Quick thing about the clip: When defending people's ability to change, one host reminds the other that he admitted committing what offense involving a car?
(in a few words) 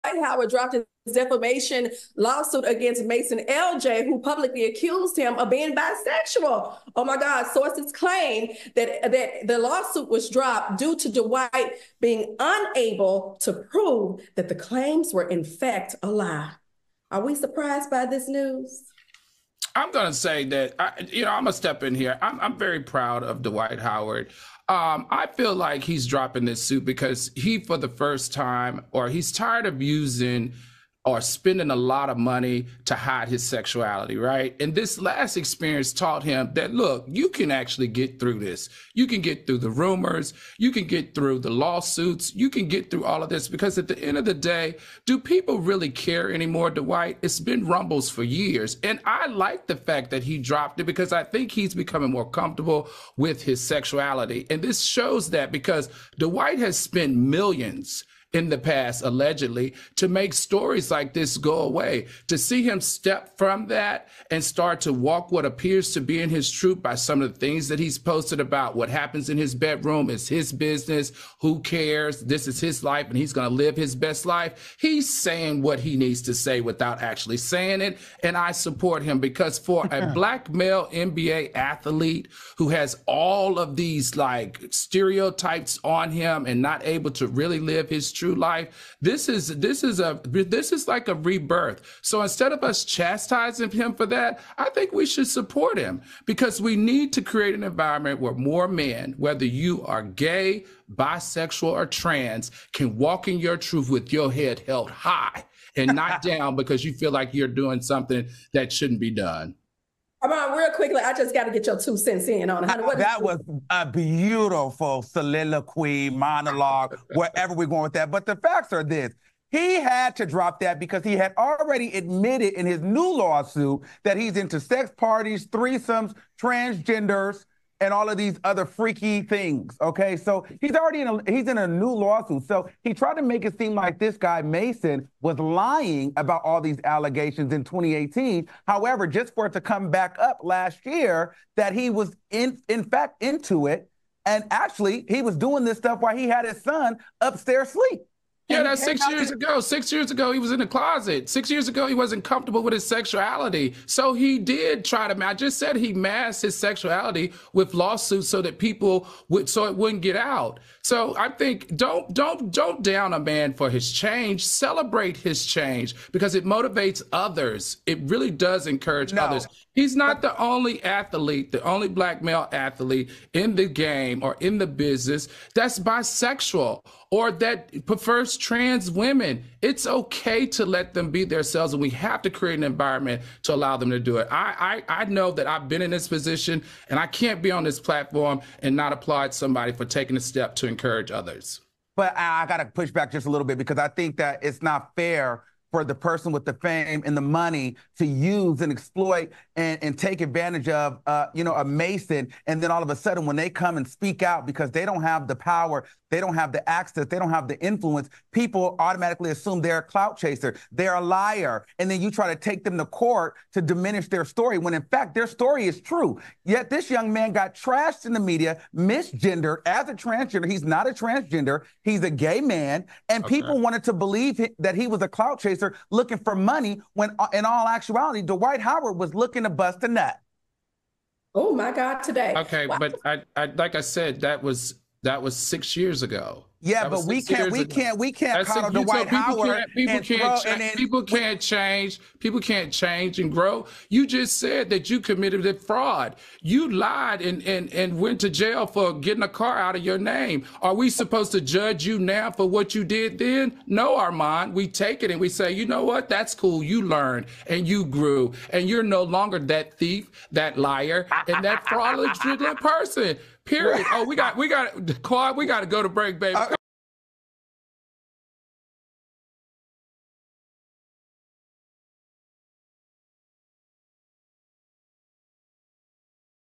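Fraud.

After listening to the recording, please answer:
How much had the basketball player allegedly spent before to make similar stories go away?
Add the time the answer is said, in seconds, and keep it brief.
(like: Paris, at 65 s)
Millions, at 57 s.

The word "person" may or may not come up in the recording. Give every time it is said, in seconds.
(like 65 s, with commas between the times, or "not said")
195 s, 262 s.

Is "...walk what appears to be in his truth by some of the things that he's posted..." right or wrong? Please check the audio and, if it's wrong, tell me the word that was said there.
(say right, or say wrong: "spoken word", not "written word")
right.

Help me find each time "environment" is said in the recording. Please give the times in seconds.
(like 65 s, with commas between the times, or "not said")
97 s, 182 s.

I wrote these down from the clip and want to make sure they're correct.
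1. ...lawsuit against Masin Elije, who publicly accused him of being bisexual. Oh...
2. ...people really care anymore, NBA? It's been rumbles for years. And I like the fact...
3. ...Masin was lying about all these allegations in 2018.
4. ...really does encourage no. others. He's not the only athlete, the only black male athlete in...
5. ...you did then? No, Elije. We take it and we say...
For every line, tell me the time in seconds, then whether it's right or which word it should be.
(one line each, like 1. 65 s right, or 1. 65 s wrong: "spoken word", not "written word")
1. 2 s right
2. 45 s wrong: "Dwight", not "NBA"
3. 134 s right
4. 168 s right
5. 252 s wrong: "Armand", not "Elije".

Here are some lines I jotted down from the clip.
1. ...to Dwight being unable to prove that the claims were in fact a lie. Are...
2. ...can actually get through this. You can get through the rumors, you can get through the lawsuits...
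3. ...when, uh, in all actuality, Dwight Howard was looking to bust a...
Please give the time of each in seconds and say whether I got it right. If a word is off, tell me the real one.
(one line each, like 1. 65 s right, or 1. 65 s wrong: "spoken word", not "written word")
1. 10 s right
2. 37 s right
3. 226 s right.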